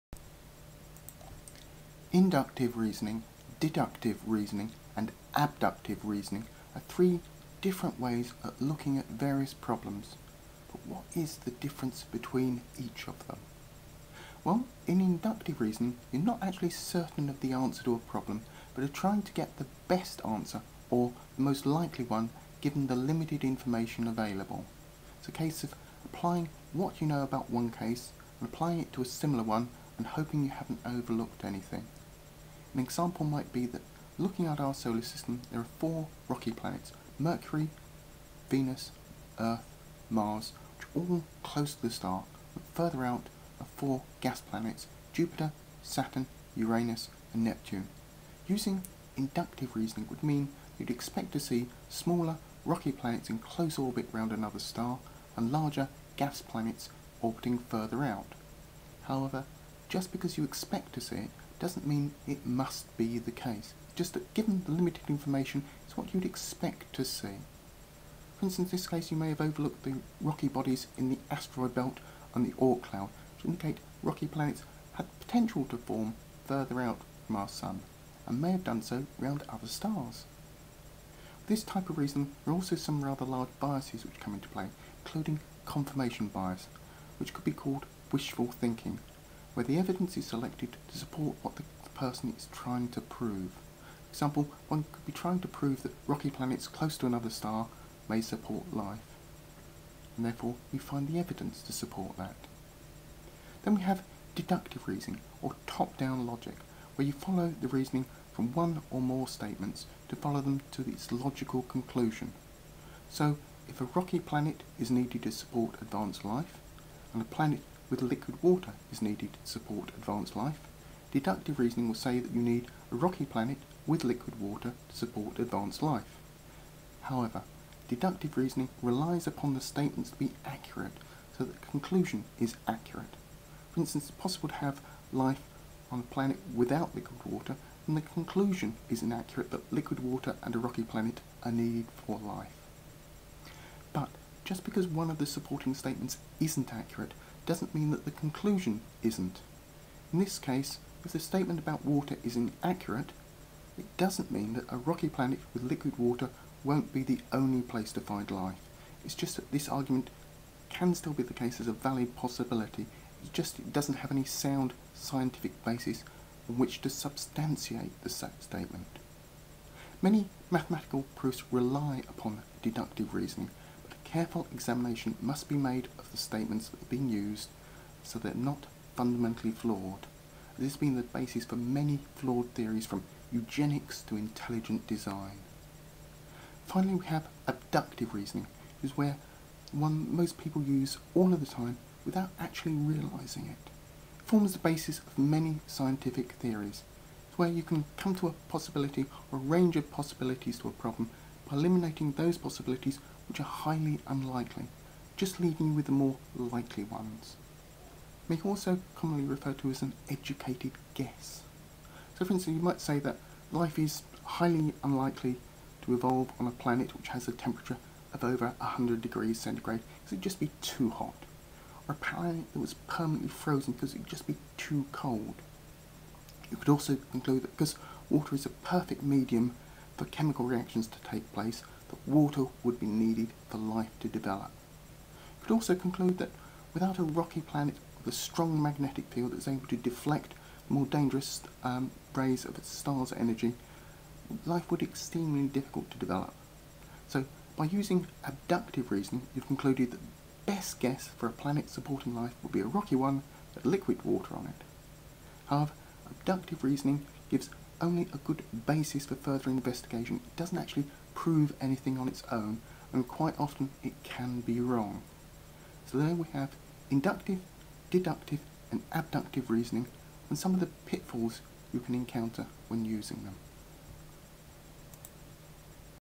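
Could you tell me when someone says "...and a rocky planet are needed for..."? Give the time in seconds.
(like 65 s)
140 s.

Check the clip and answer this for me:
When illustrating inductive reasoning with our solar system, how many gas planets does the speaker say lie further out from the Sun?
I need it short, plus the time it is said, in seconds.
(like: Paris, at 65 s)
4, at 43 s.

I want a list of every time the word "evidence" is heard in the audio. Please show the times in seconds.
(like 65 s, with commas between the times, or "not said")
89 s, 101 s.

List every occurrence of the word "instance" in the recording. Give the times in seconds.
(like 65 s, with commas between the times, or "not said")
68 s, 133 s, 212 s.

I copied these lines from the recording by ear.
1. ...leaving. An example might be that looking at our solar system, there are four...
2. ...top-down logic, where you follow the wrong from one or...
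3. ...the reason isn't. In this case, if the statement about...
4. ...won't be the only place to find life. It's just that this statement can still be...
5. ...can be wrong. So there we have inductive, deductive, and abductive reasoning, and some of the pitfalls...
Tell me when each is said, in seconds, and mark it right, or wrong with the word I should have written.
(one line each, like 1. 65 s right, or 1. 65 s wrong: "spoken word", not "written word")
1. 31 s wrong: "anything", not "leaving"
2. 105 s wrong: "reasoning", not "wrong"
3. 148 s wrong: "conclusion", not "reason"
4. 156 s wrong: "argument", not "statement"
5. 264 s right.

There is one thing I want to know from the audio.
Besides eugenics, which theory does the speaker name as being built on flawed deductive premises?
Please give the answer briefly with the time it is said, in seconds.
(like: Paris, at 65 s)
intelligent design, at 184 s.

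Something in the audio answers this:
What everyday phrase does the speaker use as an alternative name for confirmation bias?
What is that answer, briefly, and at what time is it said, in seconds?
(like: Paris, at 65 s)
wishful thinking, at 88 s.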